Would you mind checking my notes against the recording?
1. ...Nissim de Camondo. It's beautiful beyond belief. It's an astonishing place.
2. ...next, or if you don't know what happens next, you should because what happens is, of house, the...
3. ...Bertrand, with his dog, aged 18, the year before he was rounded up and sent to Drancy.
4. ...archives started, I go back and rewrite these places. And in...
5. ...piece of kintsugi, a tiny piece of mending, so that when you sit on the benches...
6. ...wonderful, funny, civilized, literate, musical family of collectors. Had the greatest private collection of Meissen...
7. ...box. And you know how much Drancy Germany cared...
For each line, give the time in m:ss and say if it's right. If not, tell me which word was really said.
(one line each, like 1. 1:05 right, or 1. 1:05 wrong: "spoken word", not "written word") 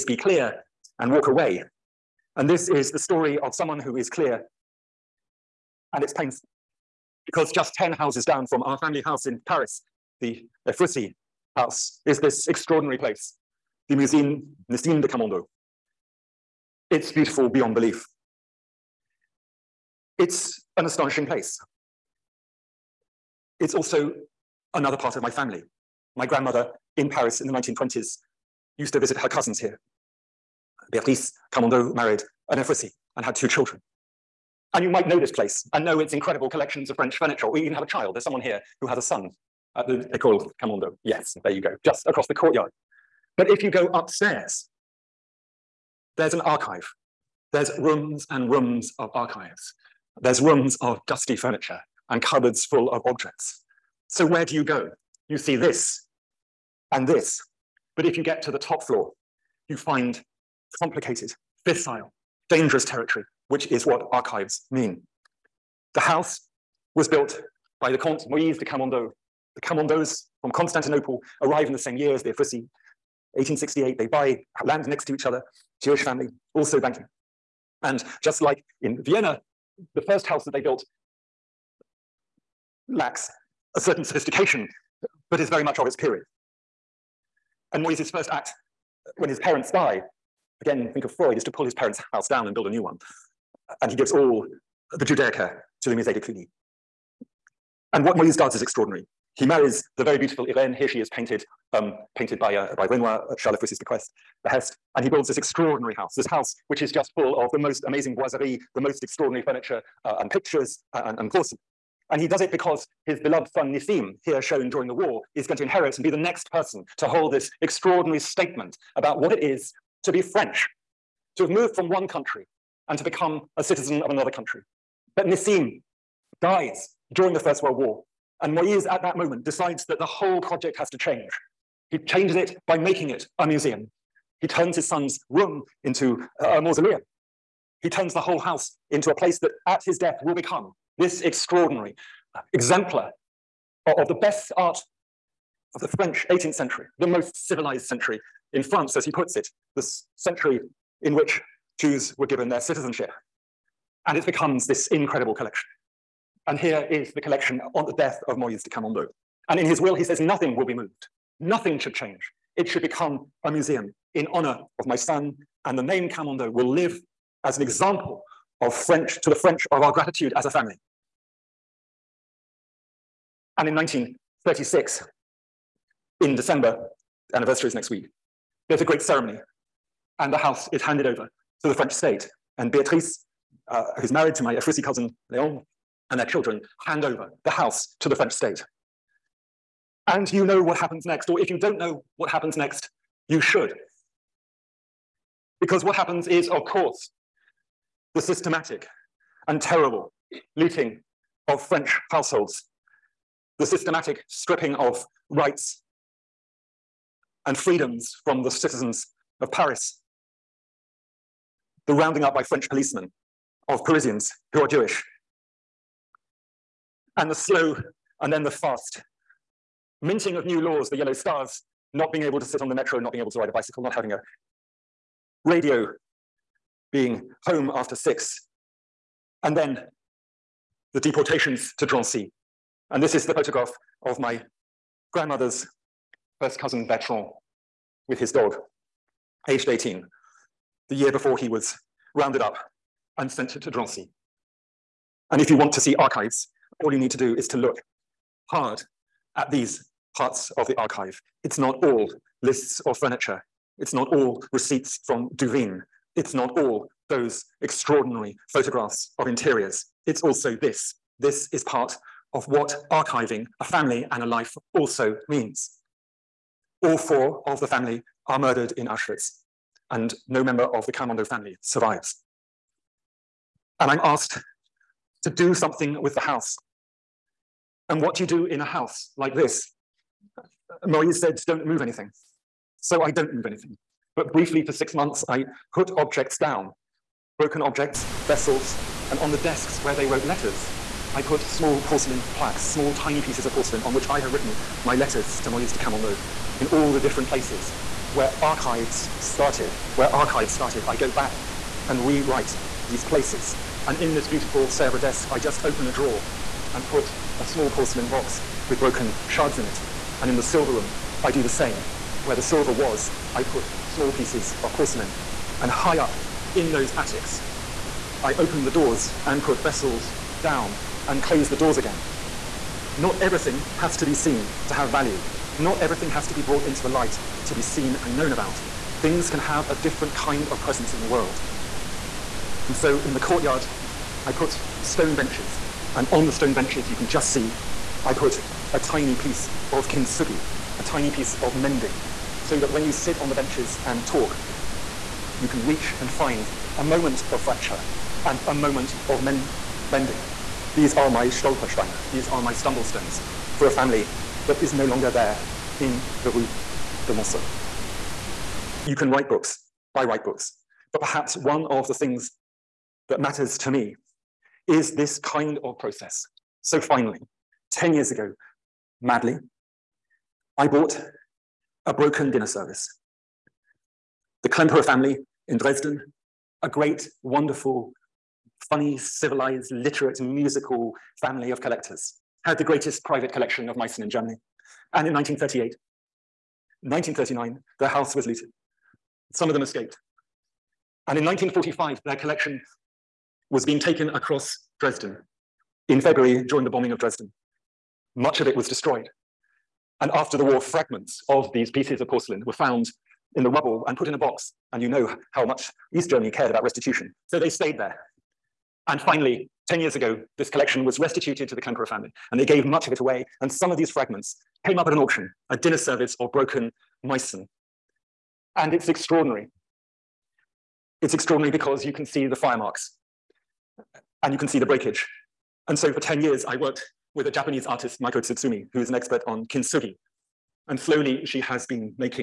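1. 0:14 right
2. 3:11 wrong: "course", not "house"
3. 3:56 right
4. 5:00 right
5. 5:39 right
6. 6:17 right
7. 6:44 wrong: "East", not "Drancy".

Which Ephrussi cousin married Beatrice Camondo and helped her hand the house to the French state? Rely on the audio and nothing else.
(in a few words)
Leon.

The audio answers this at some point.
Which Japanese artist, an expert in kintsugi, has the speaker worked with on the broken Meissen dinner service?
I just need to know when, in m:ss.
7:08.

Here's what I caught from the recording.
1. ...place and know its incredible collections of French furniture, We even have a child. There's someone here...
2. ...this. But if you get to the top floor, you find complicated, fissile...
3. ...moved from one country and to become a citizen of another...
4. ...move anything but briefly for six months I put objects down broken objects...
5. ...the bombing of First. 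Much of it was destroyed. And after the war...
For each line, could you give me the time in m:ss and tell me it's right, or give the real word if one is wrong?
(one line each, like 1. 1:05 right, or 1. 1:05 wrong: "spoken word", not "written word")
1. 0:35 right
2. 0:57 right
3. 2:01 right
4. 4:43 right
5. 6:36 wrong: "Dresden", not "First".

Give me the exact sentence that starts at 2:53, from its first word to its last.
And in 1936, in December, anniversary is next week.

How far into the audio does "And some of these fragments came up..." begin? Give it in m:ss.
6:53.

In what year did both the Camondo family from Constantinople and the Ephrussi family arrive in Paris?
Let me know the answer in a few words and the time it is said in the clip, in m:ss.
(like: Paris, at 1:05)
1868, at 1:13.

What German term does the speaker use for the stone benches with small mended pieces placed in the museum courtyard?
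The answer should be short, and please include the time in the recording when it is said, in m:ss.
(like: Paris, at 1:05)
Stolpersteine, at 5:51.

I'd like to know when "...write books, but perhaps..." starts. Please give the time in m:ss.
6:00.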